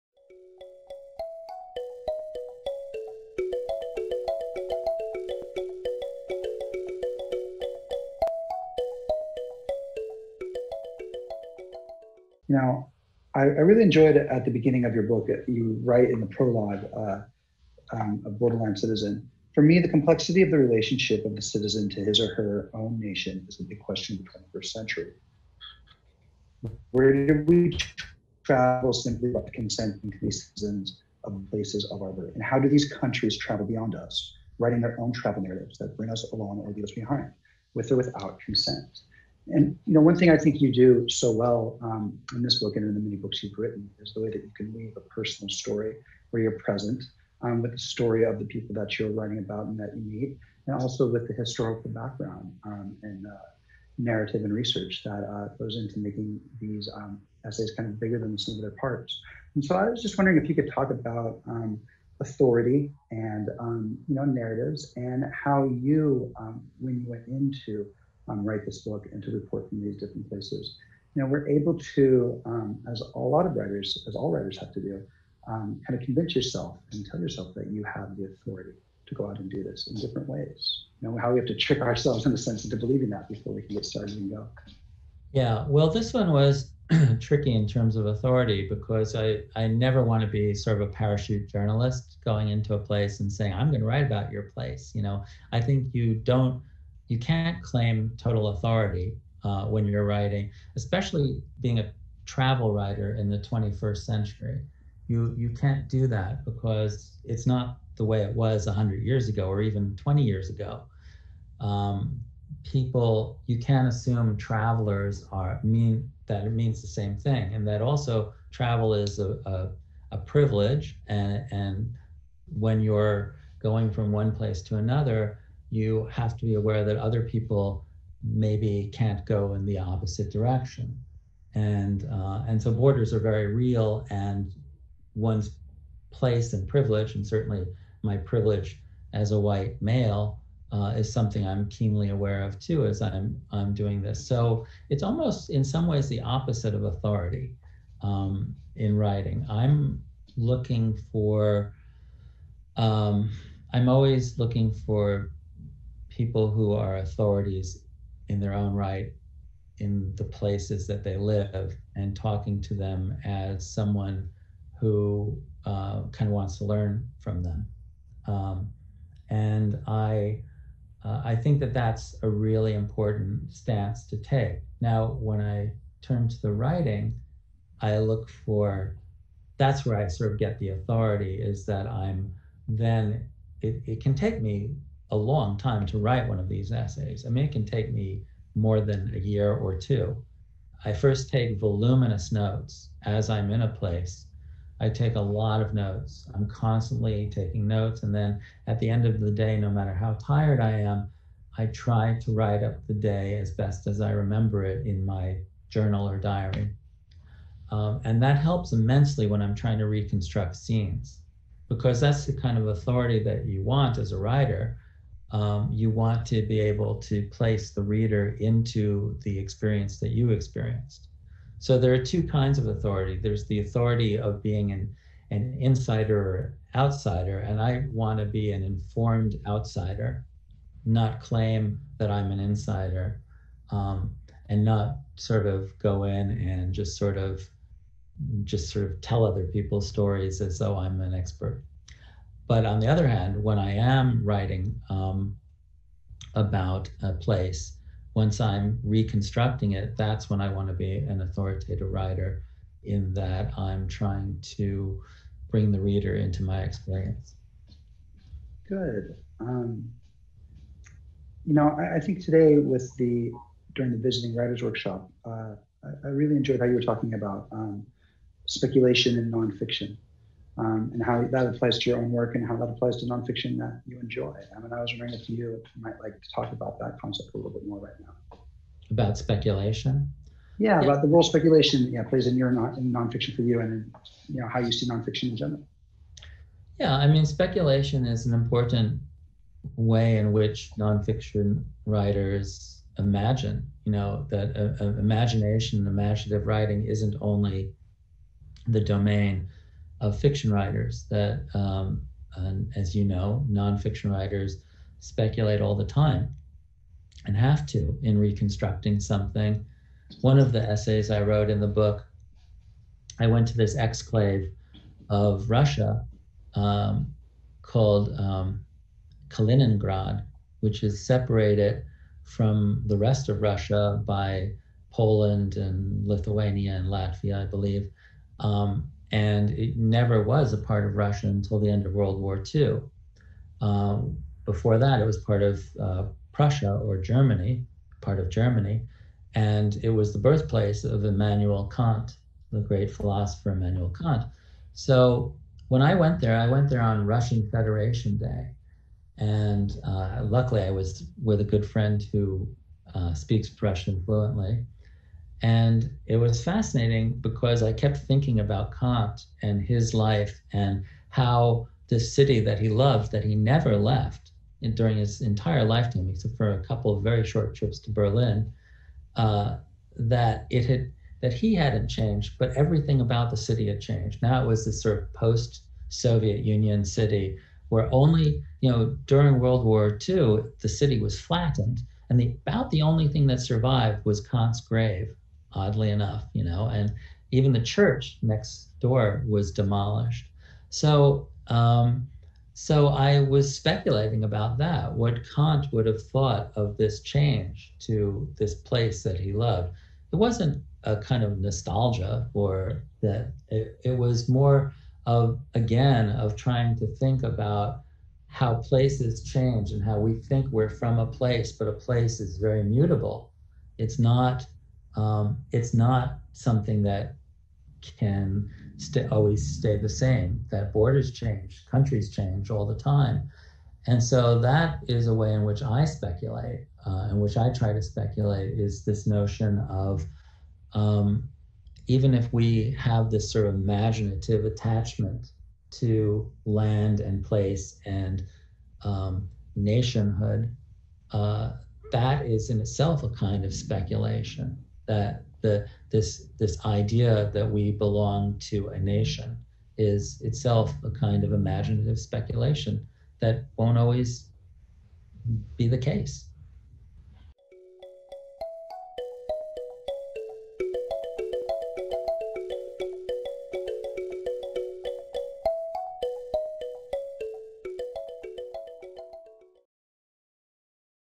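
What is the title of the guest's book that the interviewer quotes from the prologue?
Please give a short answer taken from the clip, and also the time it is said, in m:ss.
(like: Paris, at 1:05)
Borderline Citizen, at 0:18.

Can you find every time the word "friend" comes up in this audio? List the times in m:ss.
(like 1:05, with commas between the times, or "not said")
5:51.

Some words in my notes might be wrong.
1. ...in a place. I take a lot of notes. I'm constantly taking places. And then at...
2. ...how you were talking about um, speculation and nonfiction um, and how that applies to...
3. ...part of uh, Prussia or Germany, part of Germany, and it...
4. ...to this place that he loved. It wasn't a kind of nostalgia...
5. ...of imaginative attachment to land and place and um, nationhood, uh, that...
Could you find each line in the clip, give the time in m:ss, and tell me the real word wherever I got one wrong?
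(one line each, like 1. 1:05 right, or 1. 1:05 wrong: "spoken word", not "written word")
1. 3:13 wrong: "notes", not "places"
2. 4:26 right
3. 5:35 right
4. 6:37 right
5. 7:13 right.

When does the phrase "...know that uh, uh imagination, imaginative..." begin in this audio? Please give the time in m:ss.
4:53.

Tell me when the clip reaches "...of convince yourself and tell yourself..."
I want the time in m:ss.
1:15.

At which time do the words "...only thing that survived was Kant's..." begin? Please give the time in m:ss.
6:22.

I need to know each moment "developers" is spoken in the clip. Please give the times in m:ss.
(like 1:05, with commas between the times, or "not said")
not said.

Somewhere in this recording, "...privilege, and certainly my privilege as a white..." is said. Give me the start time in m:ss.
2:16.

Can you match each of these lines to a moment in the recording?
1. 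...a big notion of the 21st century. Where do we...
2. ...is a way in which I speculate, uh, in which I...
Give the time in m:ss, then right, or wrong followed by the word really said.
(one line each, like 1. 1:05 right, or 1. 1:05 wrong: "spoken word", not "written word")
1. 0:23 wrong: "question", not "notion"
2. 7:04 right.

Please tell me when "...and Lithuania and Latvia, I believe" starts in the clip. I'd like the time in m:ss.
5:25.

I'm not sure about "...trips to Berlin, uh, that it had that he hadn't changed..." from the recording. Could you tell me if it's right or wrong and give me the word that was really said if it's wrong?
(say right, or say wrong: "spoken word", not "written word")
right.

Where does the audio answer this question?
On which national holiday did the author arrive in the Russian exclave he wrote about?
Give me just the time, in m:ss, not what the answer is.
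5:47.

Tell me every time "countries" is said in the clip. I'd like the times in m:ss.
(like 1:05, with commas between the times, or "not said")
0:32, 7:01.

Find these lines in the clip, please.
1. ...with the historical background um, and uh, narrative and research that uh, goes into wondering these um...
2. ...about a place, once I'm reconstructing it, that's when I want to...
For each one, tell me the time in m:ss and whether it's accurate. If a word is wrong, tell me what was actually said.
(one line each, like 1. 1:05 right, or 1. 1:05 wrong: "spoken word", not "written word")
1. 0:51 wrong: "making", not "wondering"
2. 4:06 right.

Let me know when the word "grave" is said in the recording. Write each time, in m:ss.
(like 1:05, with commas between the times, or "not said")
6:24.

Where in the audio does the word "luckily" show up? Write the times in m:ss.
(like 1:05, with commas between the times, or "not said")
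5:50.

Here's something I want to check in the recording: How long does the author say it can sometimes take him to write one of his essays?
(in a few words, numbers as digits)
more than a year or two.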